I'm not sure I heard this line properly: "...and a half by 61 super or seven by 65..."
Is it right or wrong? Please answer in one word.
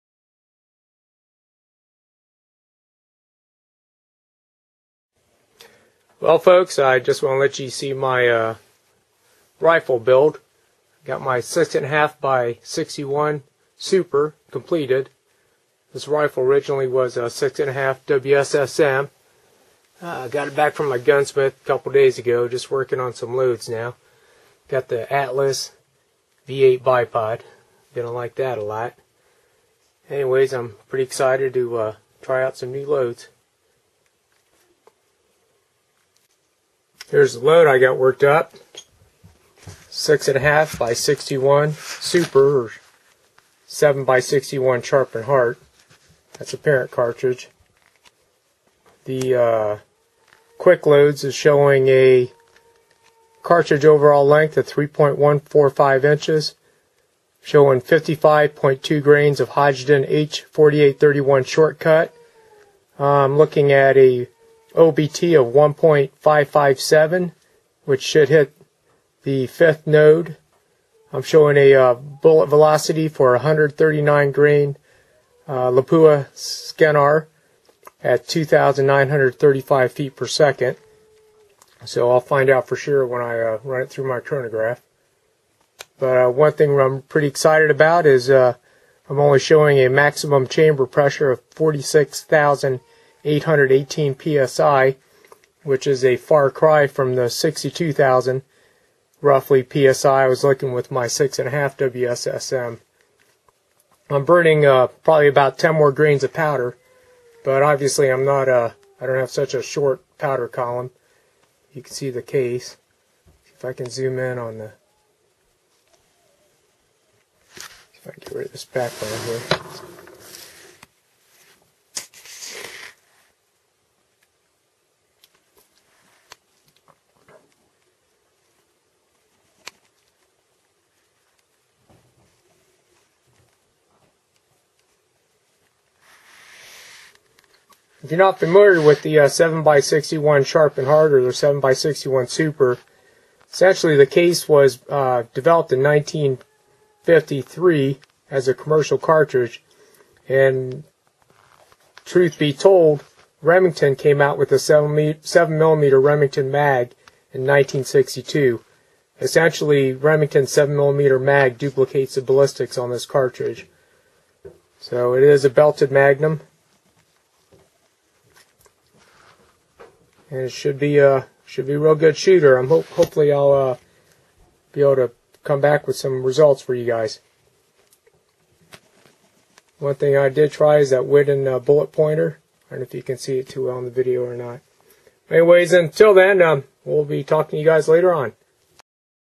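wrong.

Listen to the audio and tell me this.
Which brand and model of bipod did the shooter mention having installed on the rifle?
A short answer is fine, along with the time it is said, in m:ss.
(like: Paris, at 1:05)
Atlas V8, at 0:25.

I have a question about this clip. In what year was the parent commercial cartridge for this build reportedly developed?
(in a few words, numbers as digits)
1953.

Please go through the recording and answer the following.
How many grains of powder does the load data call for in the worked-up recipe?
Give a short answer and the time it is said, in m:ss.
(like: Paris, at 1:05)
55.2 grains, at 0:57.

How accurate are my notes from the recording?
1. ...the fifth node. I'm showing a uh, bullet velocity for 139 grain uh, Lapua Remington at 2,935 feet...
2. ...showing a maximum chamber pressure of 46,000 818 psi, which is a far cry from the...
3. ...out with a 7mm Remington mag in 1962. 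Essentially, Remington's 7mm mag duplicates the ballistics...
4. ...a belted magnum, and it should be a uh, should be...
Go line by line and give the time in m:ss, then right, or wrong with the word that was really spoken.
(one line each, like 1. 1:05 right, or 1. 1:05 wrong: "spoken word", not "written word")
1. 1:09 wrong: "Scenar", not "Remington"
2. 1:29 right
3. 2:34 right
4. 2:45 right.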